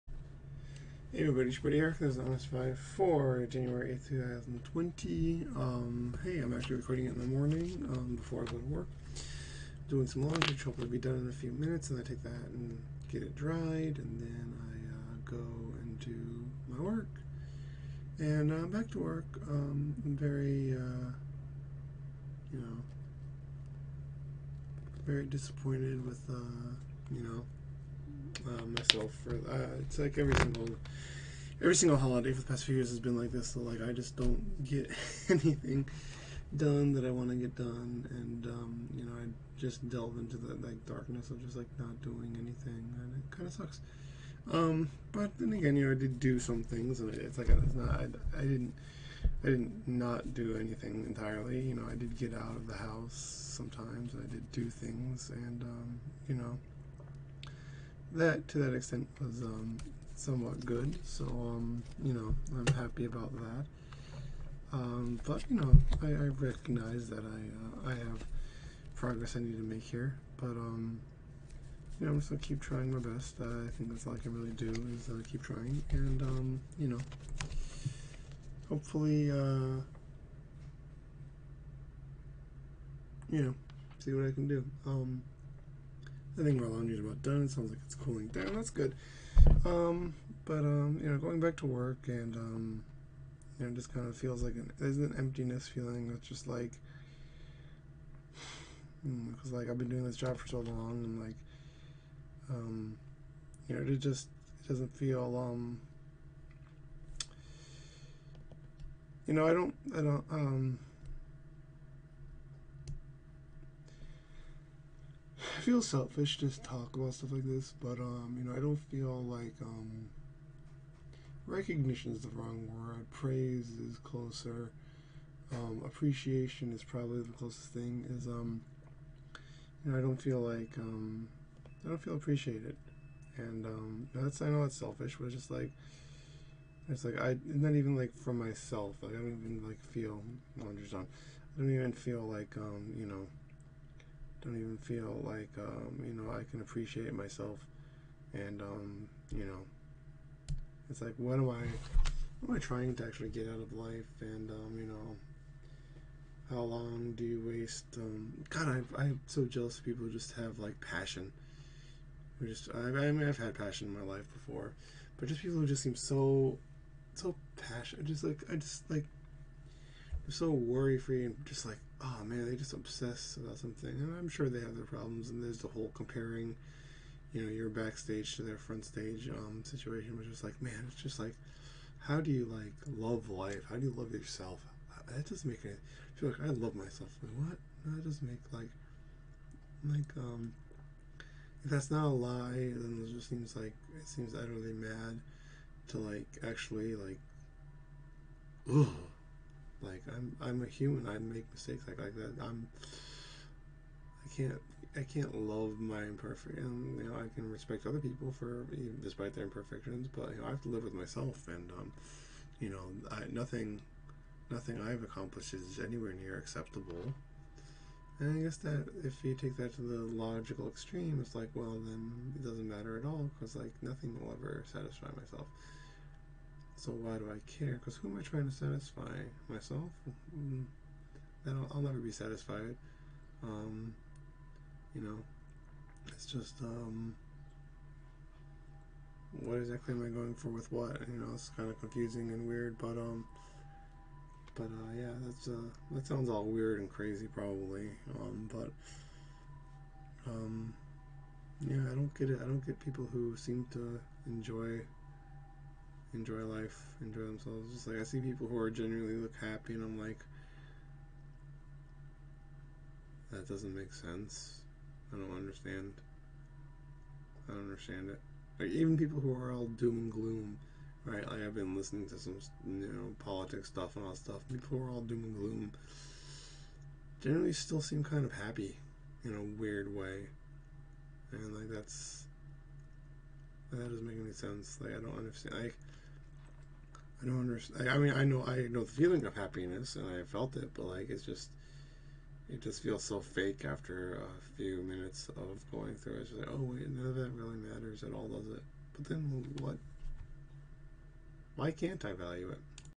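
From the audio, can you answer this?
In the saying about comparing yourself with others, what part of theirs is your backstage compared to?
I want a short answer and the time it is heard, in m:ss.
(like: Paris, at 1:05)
front stage, at 2:58.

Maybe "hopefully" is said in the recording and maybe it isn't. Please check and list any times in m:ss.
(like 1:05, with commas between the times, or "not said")
0:10, 1:18.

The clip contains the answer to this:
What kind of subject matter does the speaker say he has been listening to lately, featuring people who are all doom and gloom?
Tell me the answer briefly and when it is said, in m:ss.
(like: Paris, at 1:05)
politics, at 4:33.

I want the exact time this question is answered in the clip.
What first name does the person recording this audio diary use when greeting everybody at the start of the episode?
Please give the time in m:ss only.
0:01.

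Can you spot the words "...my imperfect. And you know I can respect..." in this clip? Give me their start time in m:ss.
3:25.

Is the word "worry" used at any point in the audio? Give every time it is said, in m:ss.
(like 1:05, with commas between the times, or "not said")
2:50.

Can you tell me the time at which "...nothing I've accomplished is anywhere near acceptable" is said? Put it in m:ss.
3:34.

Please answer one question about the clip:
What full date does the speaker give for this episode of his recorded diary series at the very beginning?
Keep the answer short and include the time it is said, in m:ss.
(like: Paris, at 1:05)
January 8, 2020, at 0:03.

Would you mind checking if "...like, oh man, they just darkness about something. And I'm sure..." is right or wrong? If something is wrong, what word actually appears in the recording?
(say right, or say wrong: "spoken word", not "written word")
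wrong: "obsess", not "darkness".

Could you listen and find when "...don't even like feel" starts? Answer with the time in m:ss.
2:19.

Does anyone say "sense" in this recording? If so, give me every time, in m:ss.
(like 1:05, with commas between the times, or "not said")
4:23, 4:44.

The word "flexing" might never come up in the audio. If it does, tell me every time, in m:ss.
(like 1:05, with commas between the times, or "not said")
not said.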